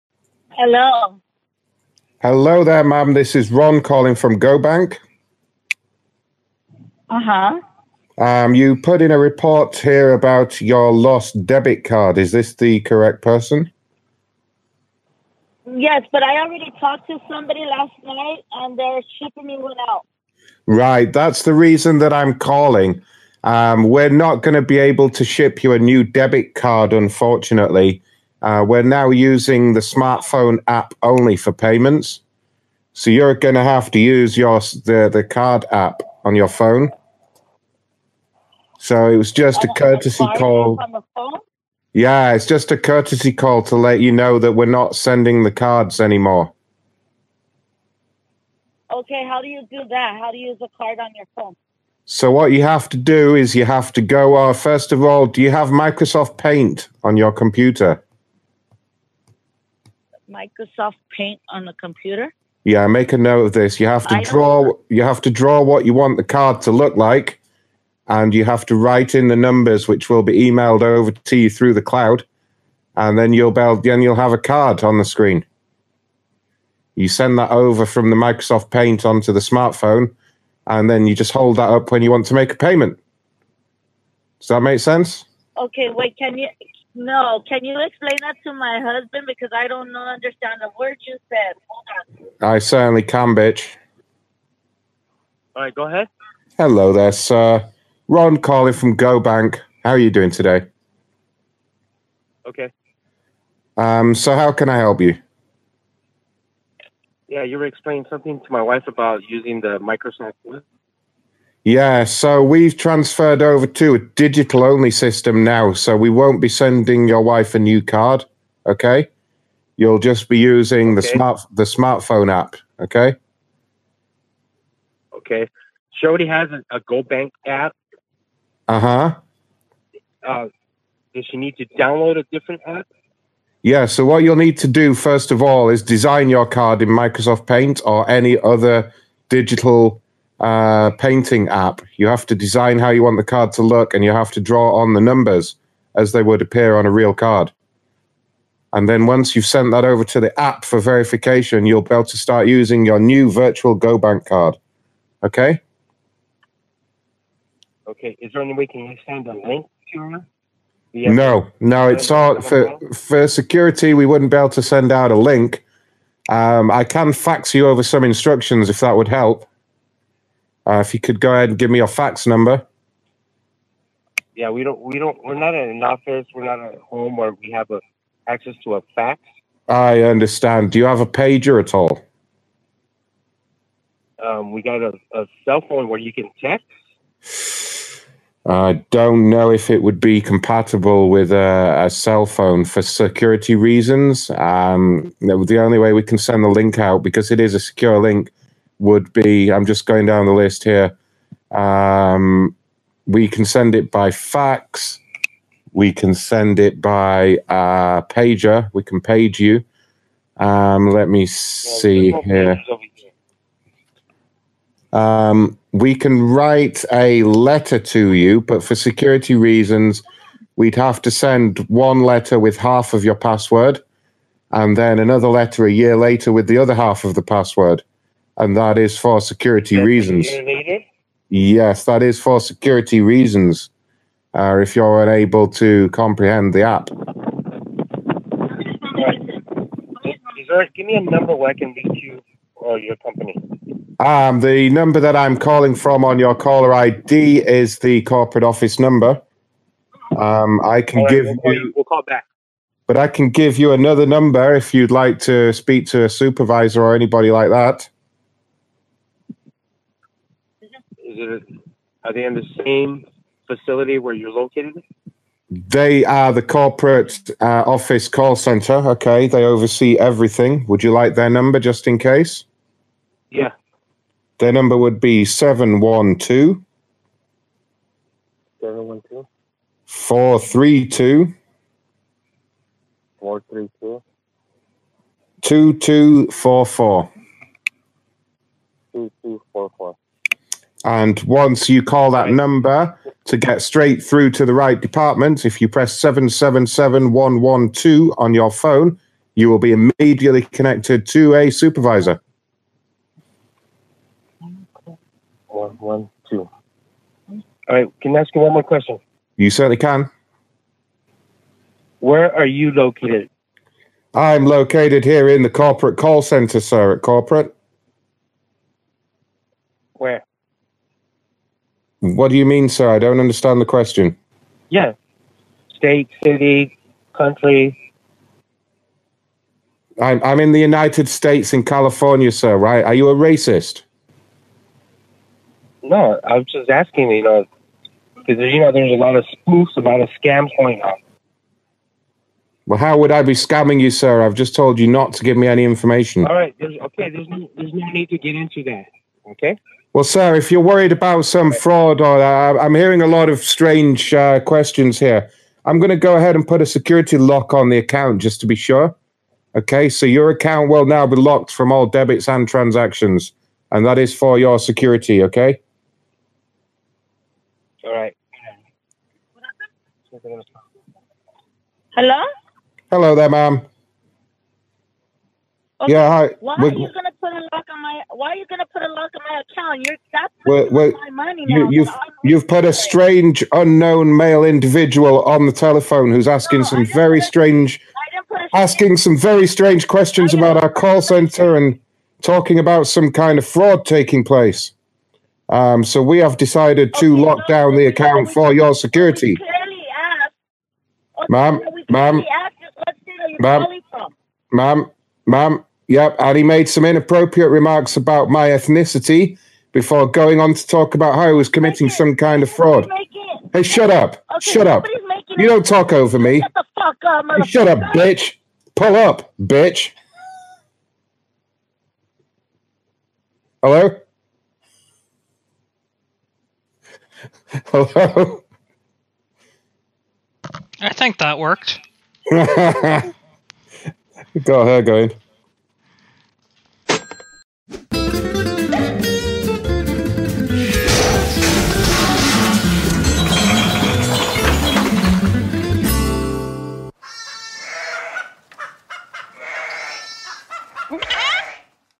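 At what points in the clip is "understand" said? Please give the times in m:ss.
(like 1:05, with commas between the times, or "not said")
1:29, 3:00, 5:23.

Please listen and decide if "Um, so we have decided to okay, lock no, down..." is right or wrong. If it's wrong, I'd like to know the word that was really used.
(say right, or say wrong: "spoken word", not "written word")
right.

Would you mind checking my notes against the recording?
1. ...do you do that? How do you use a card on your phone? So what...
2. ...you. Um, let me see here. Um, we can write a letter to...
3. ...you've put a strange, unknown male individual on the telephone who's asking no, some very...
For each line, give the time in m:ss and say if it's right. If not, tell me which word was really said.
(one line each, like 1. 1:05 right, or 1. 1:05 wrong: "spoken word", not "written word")
1. 0:49 right
2. 3:29 right
3. 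6:22 right.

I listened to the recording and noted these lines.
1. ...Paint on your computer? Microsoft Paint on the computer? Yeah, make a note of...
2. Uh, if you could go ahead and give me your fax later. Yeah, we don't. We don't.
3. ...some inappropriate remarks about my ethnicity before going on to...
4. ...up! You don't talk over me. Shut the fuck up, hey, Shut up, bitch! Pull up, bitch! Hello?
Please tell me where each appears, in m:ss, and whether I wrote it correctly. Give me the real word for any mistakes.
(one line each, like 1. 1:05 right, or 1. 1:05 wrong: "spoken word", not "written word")
1. 0:56 right
2. 2:50 wrong: "number", not "later"
3. 6:46 right
4. 6:54 right.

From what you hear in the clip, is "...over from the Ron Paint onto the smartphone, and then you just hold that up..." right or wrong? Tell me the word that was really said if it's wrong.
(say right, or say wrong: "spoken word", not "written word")
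wrong: "Microsoft", not "Ron".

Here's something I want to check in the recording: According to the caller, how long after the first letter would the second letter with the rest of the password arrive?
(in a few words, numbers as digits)
A year later.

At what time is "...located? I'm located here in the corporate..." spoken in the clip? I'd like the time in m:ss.
5:12.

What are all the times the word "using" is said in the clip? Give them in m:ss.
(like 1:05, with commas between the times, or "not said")
0:29, 1:49, 2:00, 2:32.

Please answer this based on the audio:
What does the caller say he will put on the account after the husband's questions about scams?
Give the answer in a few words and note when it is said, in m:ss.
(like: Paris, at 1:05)
A security lock, at 5:56.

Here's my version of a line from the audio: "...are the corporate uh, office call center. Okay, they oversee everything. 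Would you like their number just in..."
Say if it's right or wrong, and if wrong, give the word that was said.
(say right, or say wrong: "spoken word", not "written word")
right.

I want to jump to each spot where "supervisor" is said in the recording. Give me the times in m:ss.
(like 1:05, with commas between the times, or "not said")
4:16, 5:01.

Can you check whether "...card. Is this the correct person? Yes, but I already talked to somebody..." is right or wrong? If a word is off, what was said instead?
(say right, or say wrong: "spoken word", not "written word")
right.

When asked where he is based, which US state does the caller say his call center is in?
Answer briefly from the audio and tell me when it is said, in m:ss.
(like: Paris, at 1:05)
California, at 5:31.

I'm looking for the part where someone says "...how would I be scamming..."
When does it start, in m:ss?
5:42.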